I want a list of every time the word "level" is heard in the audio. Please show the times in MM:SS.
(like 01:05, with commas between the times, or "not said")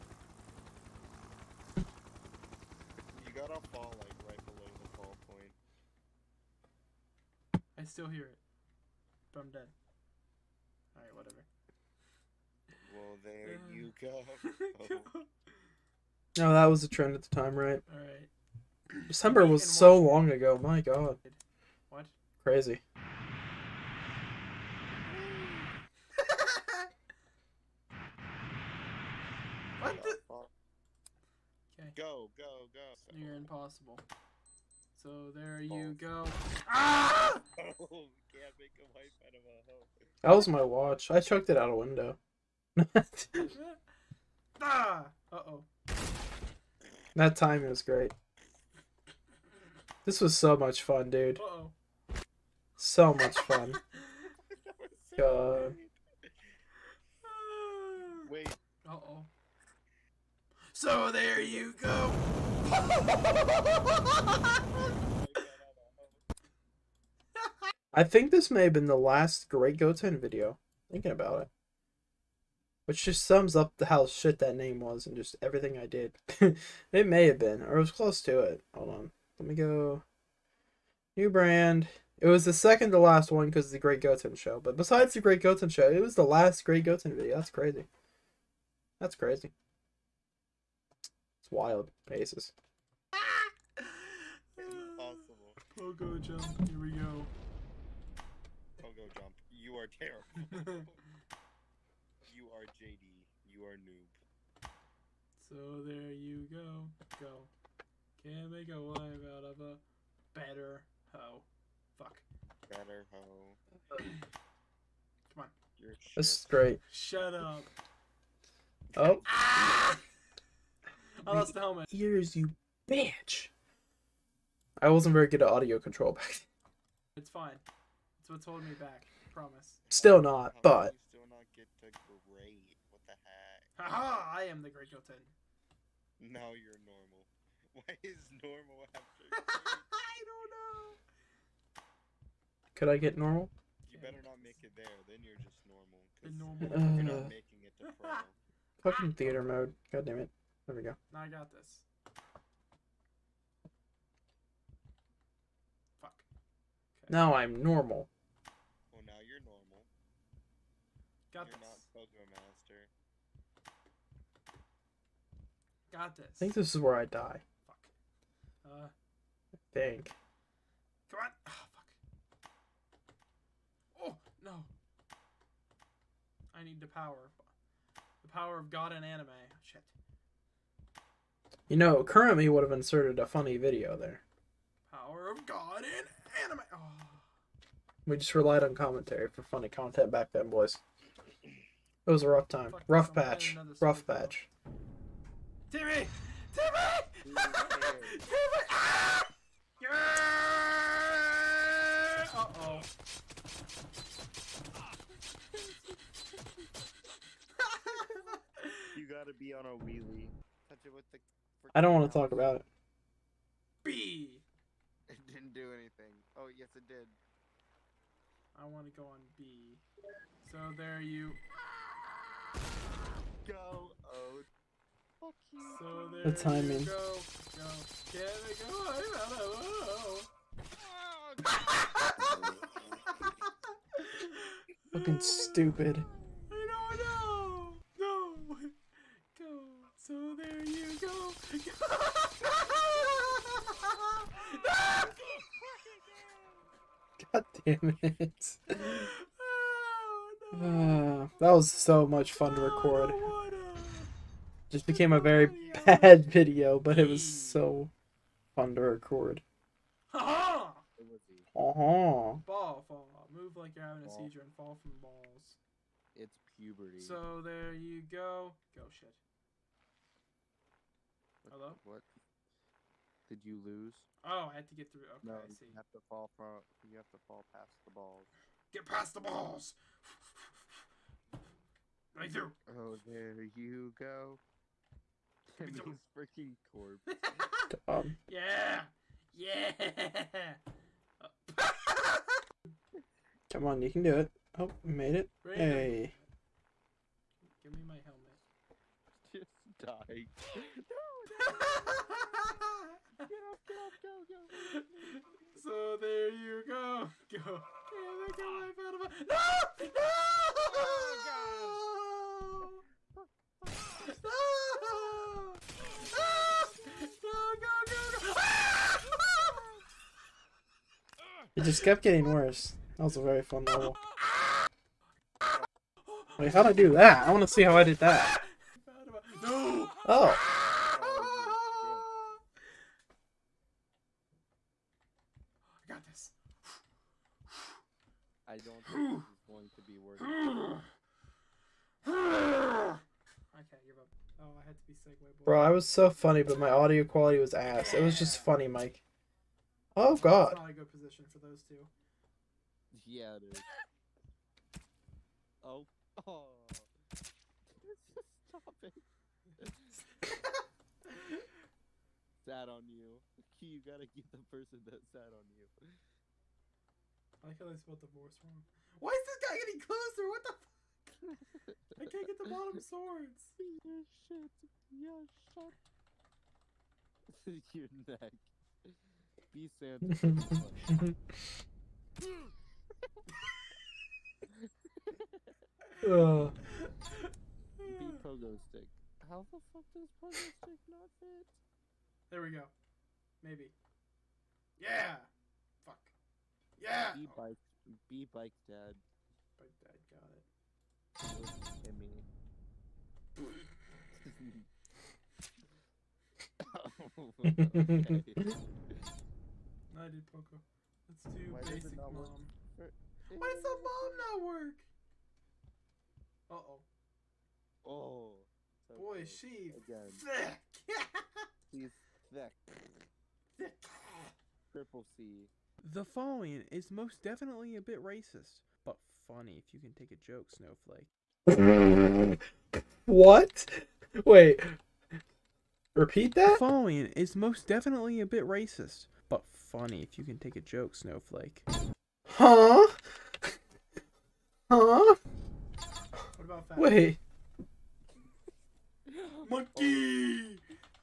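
05:23.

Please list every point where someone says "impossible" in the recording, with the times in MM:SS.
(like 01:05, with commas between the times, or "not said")
00:33, 01:34.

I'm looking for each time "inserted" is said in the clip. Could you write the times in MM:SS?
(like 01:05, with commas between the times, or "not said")
03:02.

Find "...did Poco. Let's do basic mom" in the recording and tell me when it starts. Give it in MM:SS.
06:50.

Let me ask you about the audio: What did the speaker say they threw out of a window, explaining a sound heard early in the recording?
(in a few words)
My watch.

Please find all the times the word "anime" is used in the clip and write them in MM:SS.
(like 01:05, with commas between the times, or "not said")
02:59, 03:06.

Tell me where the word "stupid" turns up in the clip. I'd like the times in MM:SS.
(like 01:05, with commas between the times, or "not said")
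03:55.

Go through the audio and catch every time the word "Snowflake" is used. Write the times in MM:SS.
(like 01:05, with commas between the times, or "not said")
07:10, 07:20.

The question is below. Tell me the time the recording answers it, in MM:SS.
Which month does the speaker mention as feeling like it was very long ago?
00:19.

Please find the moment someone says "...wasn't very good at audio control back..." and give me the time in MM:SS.
02:04.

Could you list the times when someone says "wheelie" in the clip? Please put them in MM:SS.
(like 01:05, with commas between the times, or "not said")
03:29.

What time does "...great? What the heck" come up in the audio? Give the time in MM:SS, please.
02:12.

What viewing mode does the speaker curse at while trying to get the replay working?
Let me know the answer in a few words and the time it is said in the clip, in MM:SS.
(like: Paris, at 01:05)
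Theater mode, at 02:29.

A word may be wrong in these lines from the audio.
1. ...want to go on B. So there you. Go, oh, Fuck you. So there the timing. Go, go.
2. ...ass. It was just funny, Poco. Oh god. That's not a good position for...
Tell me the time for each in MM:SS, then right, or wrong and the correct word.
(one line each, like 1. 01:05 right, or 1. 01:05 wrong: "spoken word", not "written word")
1. 03:38 right
2. 05:47 wrong: "Mike", not "Poco".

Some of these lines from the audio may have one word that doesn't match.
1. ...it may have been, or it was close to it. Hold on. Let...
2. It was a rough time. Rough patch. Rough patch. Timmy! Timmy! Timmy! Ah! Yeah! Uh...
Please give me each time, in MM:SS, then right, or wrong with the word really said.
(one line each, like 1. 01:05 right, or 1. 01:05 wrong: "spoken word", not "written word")
1. 01:16 right
2. 03:12 right.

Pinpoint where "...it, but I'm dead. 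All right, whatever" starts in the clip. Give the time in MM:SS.
00:08.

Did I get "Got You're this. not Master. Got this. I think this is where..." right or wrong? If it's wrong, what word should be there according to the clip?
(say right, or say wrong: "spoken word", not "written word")
right.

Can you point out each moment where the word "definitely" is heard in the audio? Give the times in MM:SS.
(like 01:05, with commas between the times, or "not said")
07:07, 07:17.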